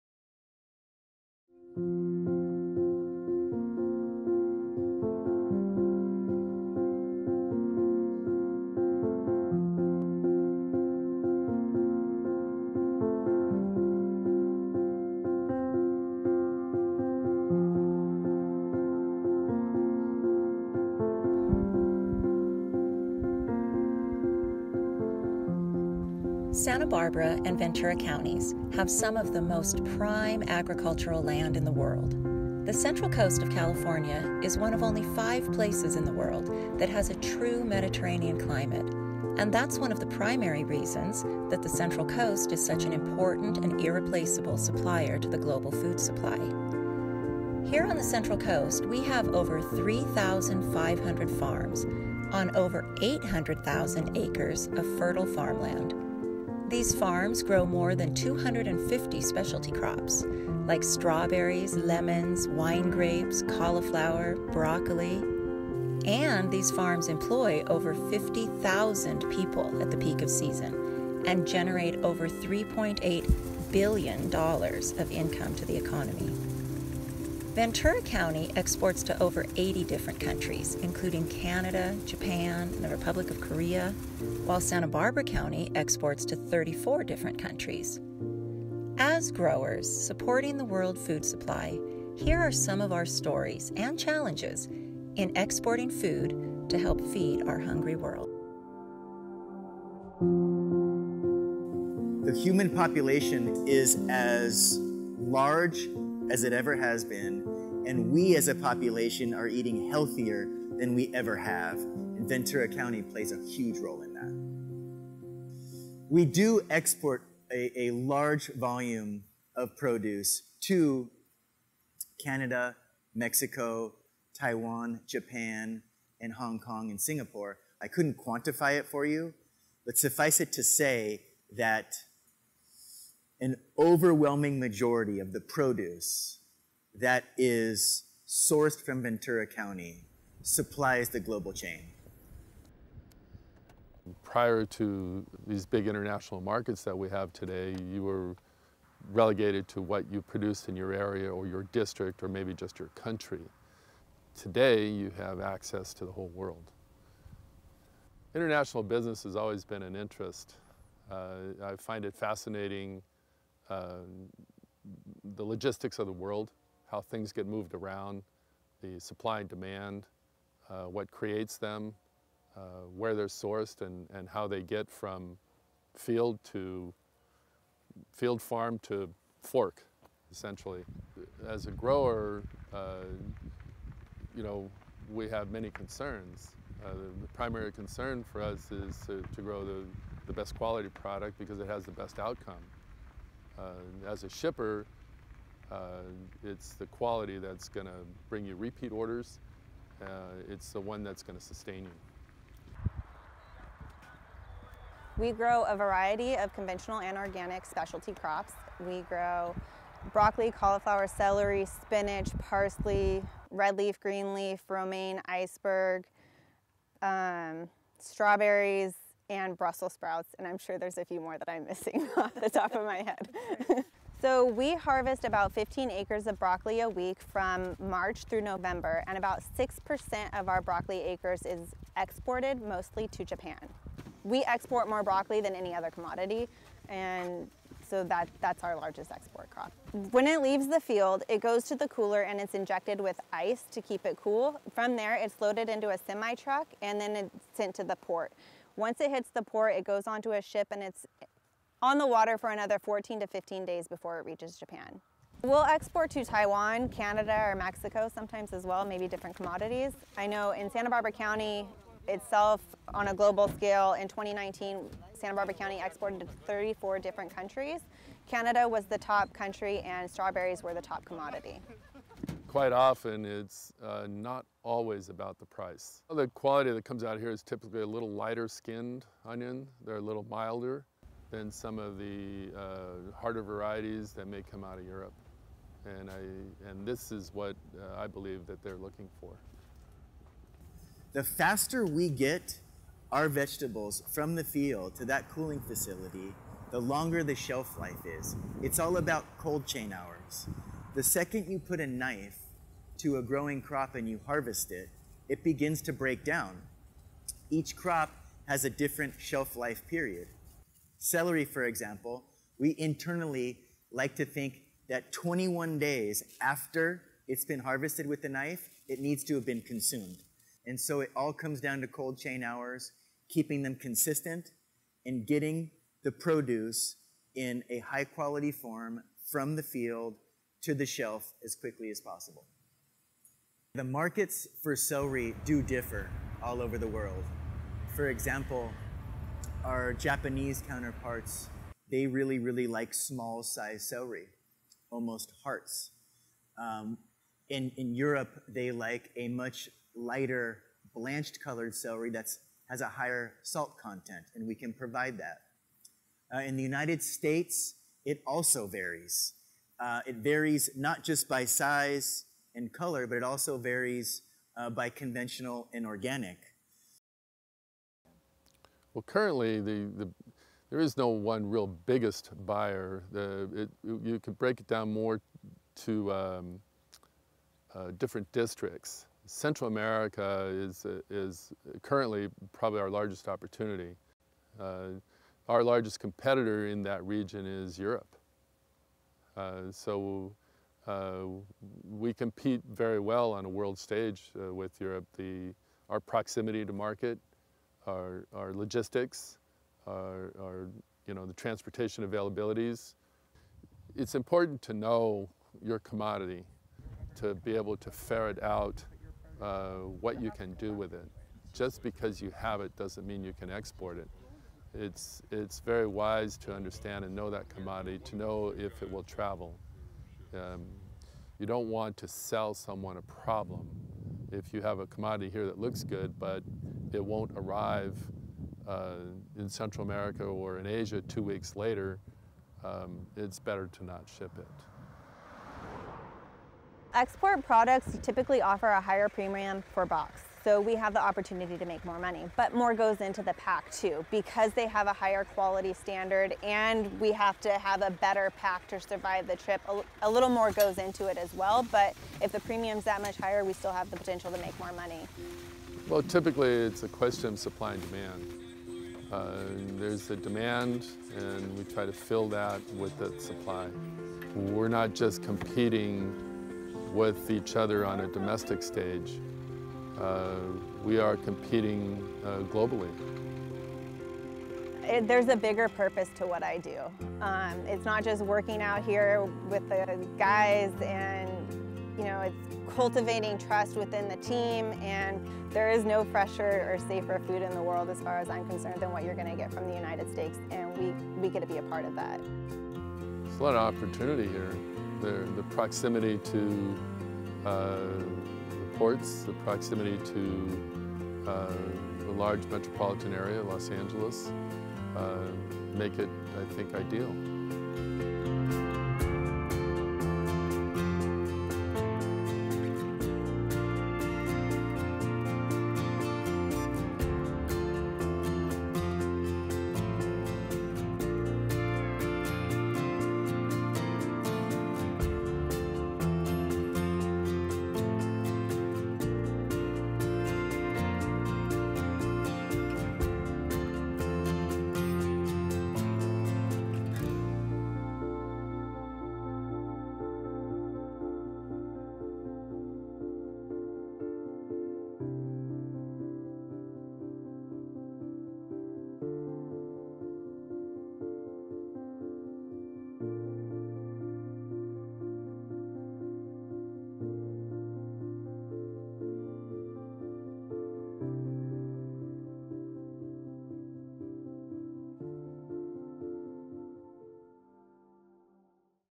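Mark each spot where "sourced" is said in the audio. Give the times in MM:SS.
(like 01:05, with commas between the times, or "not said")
02:18, 02:53.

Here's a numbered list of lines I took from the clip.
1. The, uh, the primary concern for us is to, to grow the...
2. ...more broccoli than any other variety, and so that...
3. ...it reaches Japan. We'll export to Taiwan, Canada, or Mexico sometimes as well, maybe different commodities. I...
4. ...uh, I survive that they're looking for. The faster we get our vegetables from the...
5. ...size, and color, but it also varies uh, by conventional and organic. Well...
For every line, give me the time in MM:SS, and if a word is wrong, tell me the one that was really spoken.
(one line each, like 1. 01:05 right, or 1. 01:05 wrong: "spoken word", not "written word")
1. 03:06 right
2. 03:54 wrong: "commodity", not "variety"
3. 04:14 right
4. 04:47 wrong: "believe", not "survive"
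5. 06:01 right.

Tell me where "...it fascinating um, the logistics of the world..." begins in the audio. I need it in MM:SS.
02:42.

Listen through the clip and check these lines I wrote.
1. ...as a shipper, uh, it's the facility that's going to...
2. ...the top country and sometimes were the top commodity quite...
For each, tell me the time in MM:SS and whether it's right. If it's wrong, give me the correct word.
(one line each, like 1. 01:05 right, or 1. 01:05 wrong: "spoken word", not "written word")
1. 03:14 wrong: "quality", not "facility"
2. 04:28 wrong: "strawberries", not "sometimes".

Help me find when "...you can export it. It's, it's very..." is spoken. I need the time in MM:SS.
06:53.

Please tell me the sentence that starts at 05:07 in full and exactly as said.
Each crop has a different shelf life period.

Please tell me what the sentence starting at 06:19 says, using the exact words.
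Central America is, is currently probably our largest opportunity.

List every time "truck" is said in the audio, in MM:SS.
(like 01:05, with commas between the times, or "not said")
04:06.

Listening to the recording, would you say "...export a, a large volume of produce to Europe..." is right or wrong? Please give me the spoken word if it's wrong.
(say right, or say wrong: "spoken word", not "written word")
wrong: "Canada", not "Europe".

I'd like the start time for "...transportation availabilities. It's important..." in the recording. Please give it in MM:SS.
06:41.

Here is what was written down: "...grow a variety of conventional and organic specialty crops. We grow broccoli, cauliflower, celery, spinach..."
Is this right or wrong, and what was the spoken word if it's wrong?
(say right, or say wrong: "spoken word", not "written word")
right.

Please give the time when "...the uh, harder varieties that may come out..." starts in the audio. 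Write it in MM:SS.
04:41.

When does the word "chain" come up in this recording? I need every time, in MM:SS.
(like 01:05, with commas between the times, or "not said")
02:21, 04:59, 05:22.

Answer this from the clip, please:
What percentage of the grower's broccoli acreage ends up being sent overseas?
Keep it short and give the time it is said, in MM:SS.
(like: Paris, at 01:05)
6%, at 03:49.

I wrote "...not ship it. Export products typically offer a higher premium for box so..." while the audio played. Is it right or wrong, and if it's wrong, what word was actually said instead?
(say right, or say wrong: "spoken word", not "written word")
right.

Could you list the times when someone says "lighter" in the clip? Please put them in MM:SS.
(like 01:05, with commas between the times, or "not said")
04:38, 05:49.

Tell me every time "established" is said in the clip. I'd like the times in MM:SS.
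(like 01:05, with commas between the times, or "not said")
not said.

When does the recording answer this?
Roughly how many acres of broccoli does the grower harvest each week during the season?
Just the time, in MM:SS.
03:45.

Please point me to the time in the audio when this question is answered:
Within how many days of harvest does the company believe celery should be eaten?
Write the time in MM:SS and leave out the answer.
05:15.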